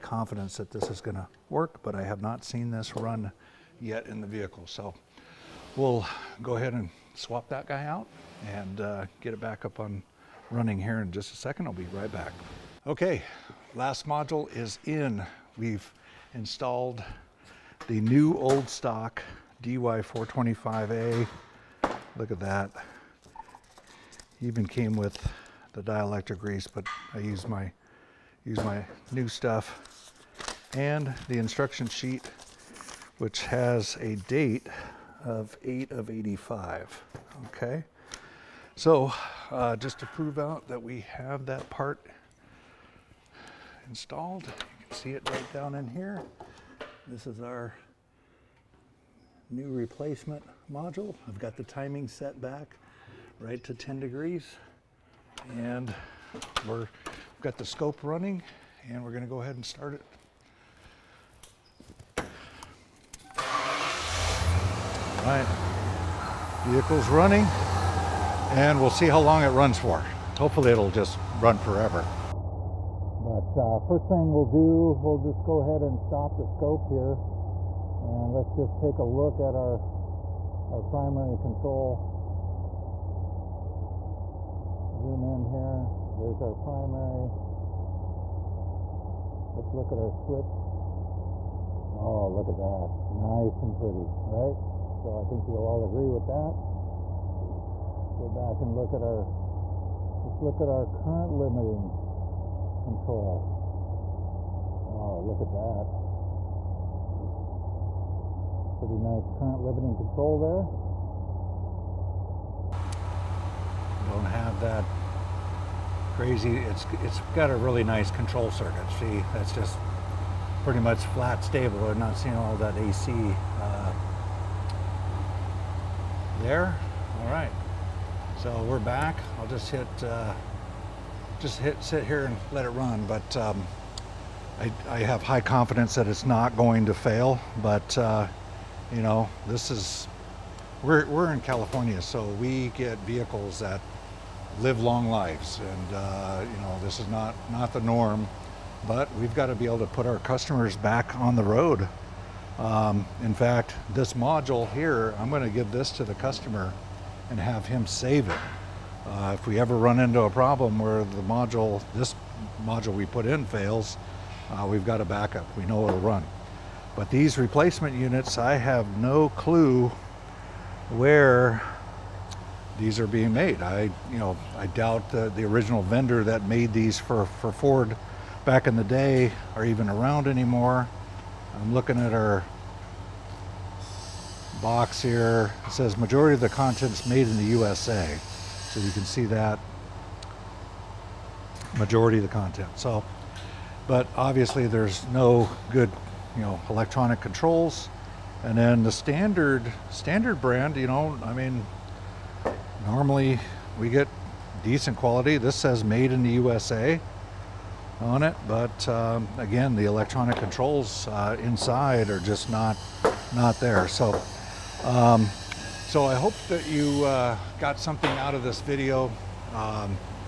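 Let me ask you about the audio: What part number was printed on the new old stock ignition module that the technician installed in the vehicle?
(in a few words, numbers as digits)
DY425A.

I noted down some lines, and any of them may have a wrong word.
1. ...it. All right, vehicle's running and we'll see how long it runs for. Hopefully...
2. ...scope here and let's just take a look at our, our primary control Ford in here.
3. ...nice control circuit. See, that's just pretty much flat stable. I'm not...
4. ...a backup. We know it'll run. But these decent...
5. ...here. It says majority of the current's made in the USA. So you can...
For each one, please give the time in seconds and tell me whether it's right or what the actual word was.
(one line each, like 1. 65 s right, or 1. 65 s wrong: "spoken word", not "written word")
1. 59 s right
2. 76 s wrong: "Zoom", not "Ford"
3. 117 s right
4. 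164 s wrong: "replacement", not "decent"
5. 185 s wrong: "content", not "current".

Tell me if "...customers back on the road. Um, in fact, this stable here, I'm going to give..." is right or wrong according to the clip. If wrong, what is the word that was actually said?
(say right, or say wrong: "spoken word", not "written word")
wrong: "module", not "stable".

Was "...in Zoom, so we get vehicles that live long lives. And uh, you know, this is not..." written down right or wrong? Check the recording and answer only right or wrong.
wrong.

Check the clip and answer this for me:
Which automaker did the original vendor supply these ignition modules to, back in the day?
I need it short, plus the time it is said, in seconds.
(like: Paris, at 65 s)
Ford, at 177 s.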